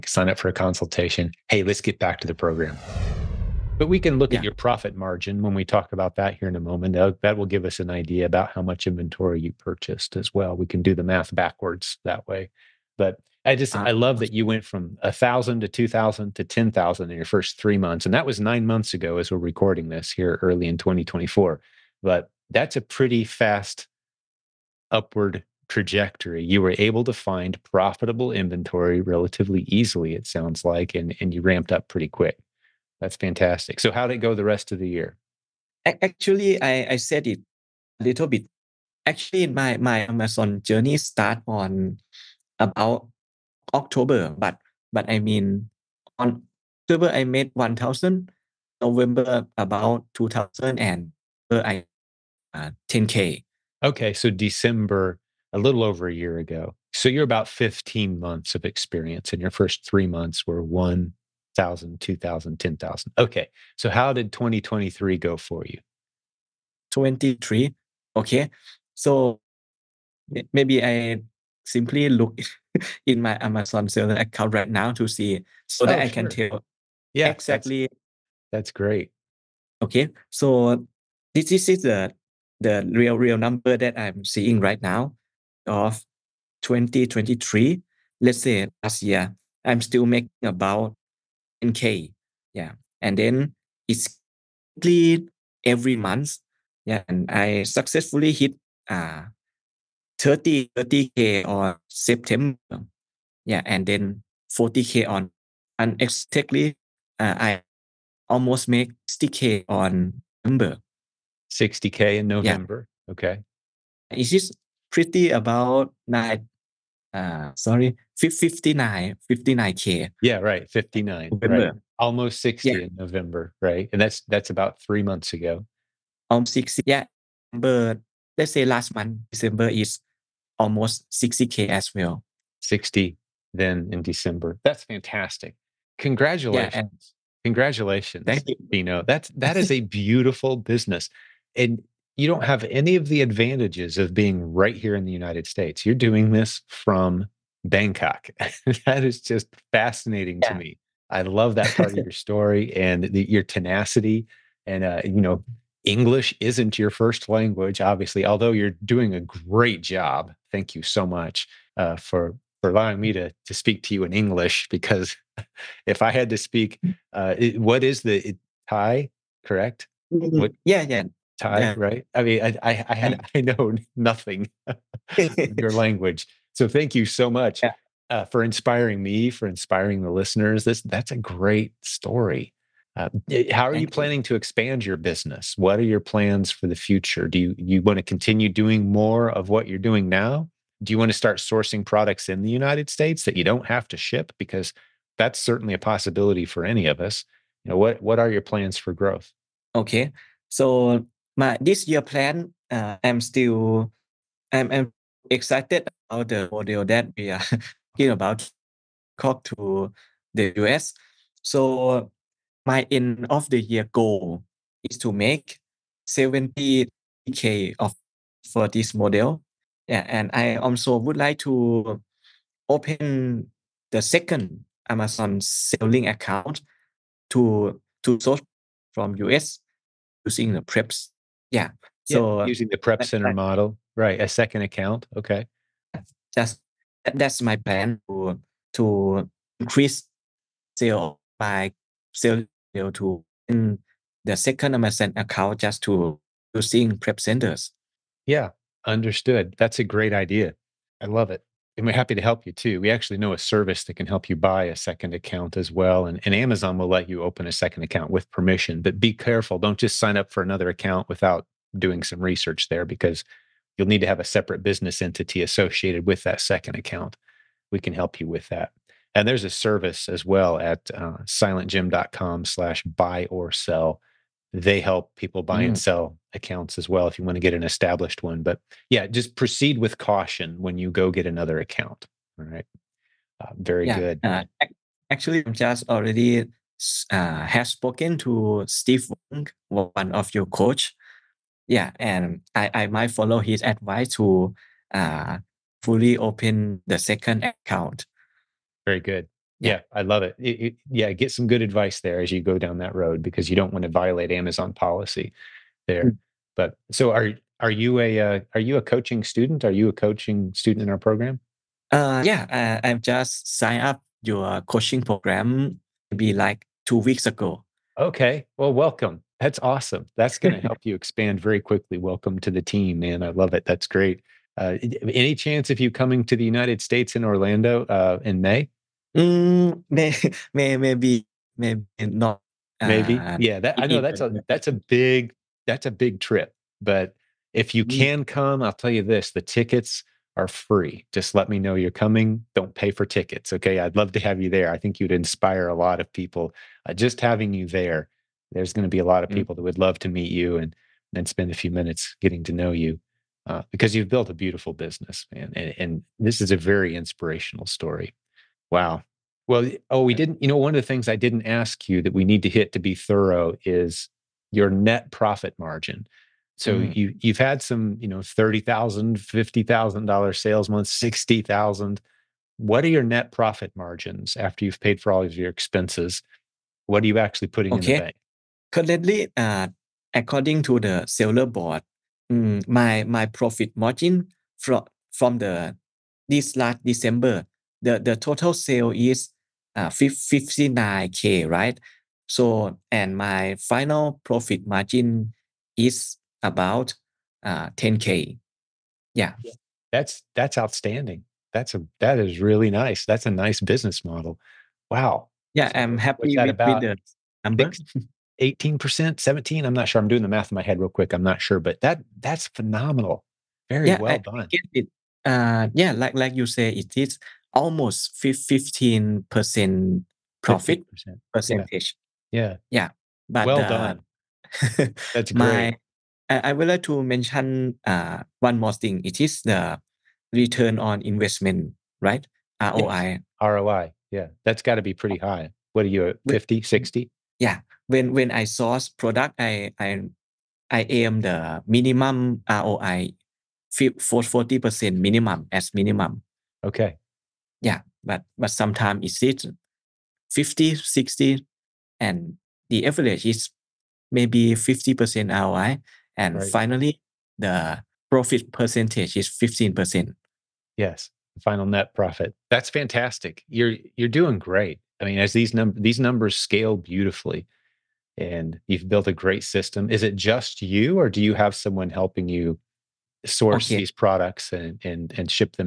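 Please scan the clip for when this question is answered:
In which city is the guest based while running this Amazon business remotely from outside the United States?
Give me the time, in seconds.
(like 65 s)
147 s.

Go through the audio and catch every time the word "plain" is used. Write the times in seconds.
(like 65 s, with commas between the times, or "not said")
not said.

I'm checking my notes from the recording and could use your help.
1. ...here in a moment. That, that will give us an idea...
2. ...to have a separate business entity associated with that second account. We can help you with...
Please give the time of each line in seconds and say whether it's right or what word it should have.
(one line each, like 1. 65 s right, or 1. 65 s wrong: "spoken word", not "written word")
1. 6 s right
2. 264 s right.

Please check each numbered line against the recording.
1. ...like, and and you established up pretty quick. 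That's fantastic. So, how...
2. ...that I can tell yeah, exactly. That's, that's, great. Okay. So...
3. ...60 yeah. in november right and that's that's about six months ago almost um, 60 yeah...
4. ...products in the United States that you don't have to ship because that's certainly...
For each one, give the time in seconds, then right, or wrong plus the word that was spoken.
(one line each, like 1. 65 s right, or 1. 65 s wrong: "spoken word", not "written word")
1. 30 s wrong: "ramped", not "established"
2. 75 s right
3. 122 s wrong: "three", not "six"
4. 191 s right.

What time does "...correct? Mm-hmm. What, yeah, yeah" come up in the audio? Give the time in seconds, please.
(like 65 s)
169 s.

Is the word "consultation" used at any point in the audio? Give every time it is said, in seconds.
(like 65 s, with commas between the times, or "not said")
0 s.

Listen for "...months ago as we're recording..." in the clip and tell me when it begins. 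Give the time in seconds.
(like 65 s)
18 s.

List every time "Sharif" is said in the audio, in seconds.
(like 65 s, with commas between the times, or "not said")
not said.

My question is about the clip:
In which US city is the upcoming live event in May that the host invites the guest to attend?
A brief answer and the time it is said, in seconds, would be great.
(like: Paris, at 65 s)
Orlando, at 327 s.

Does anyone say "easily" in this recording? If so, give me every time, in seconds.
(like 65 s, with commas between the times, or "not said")
29 s.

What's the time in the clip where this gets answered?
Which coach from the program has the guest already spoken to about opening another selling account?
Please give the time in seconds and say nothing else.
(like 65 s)
288 s.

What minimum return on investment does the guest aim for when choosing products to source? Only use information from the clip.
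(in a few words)
40%.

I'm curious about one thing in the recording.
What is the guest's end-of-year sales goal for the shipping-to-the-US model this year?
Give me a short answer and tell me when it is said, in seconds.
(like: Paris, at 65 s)
70k, at 216 s.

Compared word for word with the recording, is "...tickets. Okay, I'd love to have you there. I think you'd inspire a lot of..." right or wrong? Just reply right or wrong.
right.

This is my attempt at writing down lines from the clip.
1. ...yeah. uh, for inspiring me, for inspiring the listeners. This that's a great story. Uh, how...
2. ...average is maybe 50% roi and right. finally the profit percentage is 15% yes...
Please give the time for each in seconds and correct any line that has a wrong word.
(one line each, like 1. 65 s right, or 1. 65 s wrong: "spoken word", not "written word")
1. 177 s right
2. 452 s right.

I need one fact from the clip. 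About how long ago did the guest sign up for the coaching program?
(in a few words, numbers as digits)
two weeks ago.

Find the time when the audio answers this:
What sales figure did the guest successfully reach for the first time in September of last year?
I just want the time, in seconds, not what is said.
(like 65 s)
100 s.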